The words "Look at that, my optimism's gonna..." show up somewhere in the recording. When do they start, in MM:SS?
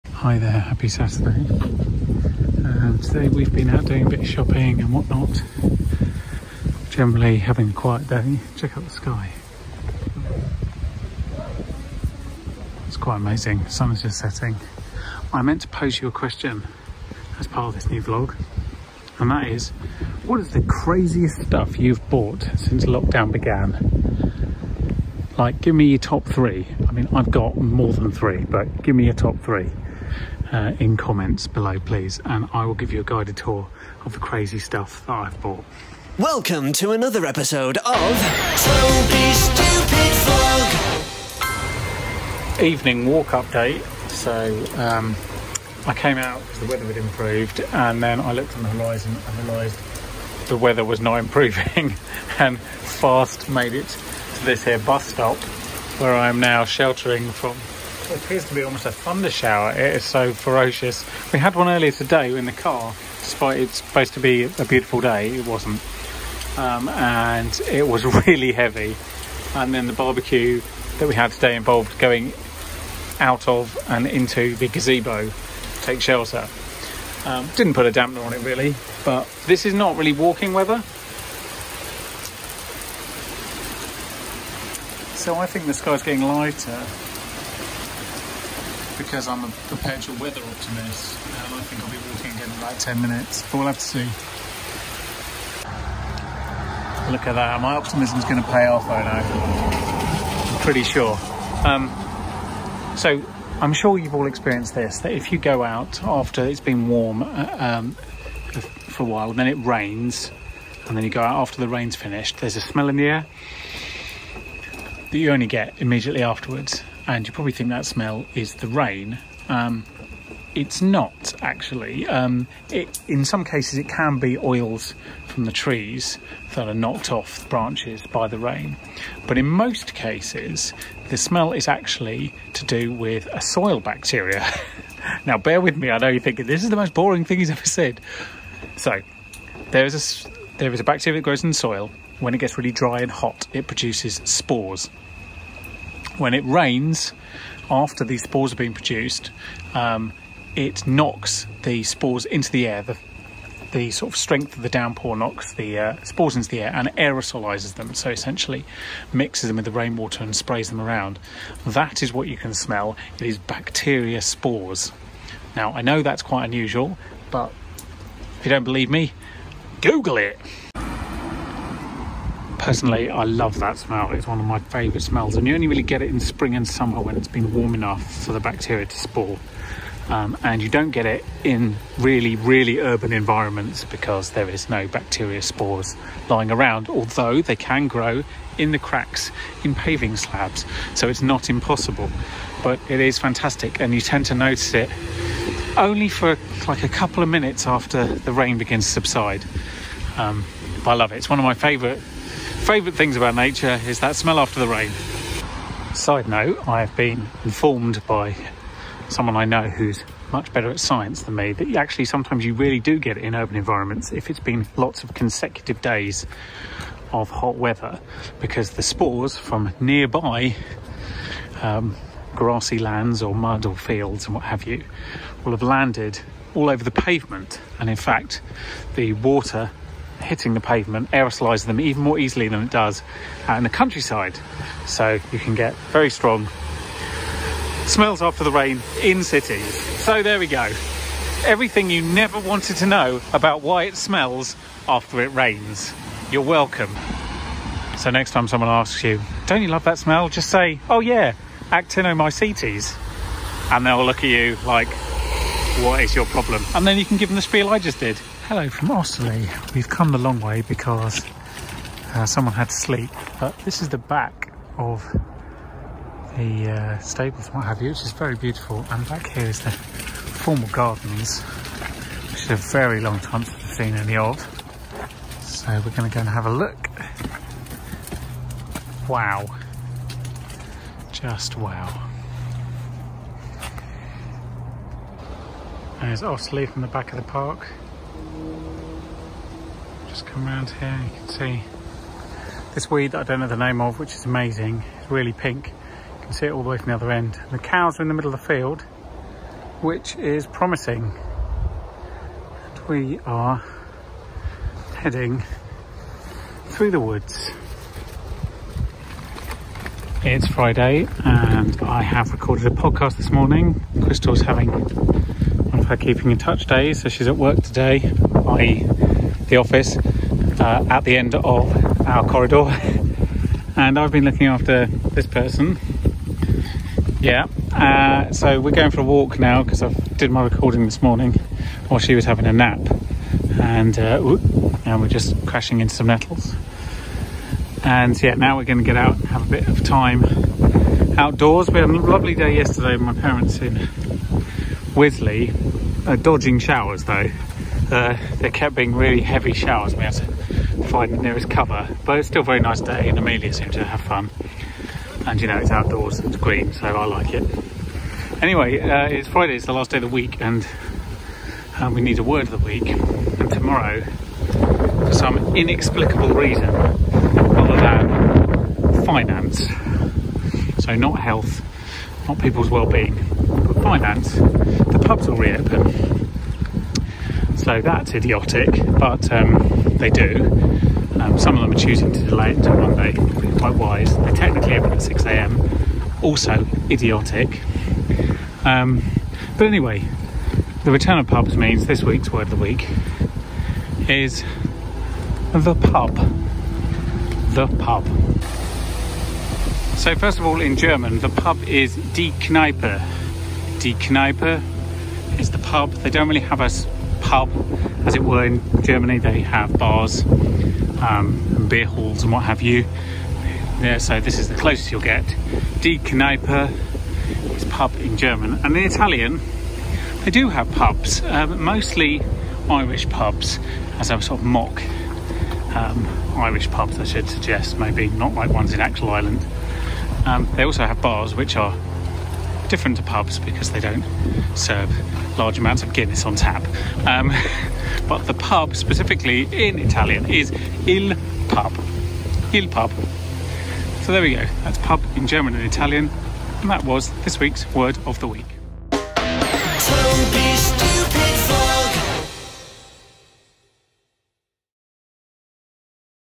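01:37.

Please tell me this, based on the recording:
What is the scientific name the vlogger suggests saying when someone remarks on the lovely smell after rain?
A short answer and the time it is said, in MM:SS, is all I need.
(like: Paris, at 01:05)
Actinomycetes, at 04:11.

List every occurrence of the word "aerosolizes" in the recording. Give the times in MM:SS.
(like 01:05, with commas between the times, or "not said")
02:36, 03:51.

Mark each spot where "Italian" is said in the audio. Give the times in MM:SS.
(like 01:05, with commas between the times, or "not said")
06:58, 07:19, 07:25.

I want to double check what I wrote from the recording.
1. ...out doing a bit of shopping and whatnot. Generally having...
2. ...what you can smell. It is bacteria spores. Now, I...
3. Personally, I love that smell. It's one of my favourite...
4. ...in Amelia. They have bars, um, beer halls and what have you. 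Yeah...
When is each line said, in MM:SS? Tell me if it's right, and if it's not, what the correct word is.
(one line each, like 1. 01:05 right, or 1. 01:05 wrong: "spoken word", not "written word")
1. 00:03 right
2. 02:42 right
3. 02:52 right
4. 06:48 wrong: "Germany", not "Amelia".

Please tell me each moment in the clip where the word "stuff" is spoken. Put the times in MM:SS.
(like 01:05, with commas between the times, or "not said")
00:21, 00:34.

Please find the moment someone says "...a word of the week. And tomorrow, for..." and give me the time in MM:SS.
06:02.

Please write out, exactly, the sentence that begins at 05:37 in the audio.
And yeah, now we're going to get out and have a bit of time outdoors.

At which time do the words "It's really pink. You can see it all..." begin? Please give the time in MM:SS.
04:54.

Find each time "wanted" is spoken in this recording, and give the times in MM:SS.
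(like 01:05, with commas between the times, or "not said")
04:02.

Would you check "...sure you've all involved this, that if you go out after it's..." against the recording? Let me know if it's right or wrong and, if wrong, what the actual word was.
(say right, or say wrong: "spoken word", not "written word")
wrong: "experienced", not "involved".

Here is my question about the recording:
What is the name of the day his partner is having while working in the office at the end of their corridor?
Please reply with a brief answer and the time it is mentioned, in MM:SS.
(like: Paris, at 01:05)
Keeping in Touch Day, at 05:15.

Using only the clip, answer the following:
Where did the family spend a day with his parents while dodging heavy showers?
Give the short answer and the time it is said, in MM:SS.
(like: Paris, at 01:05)
Wisley, at 05:44.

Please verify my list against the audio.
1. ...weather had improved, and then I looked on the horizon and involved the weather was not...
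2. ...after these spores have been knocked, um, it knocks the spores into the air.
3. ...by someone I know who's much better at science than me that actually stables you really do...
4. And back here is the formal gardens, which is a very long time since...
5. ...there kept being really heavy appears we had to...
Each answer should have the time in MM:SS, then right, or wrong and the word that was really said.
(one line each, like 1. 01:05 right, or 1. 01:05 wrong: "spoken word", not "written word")
1. 00:46 wrong: "realised", not "involved"
2. 02:27 wrong: "produced", not "knocked"
3. 03:28 wrong: "sometimes", not "stables"
4. 04:28 right
5. 05:48 wrong: "showers", not "appears".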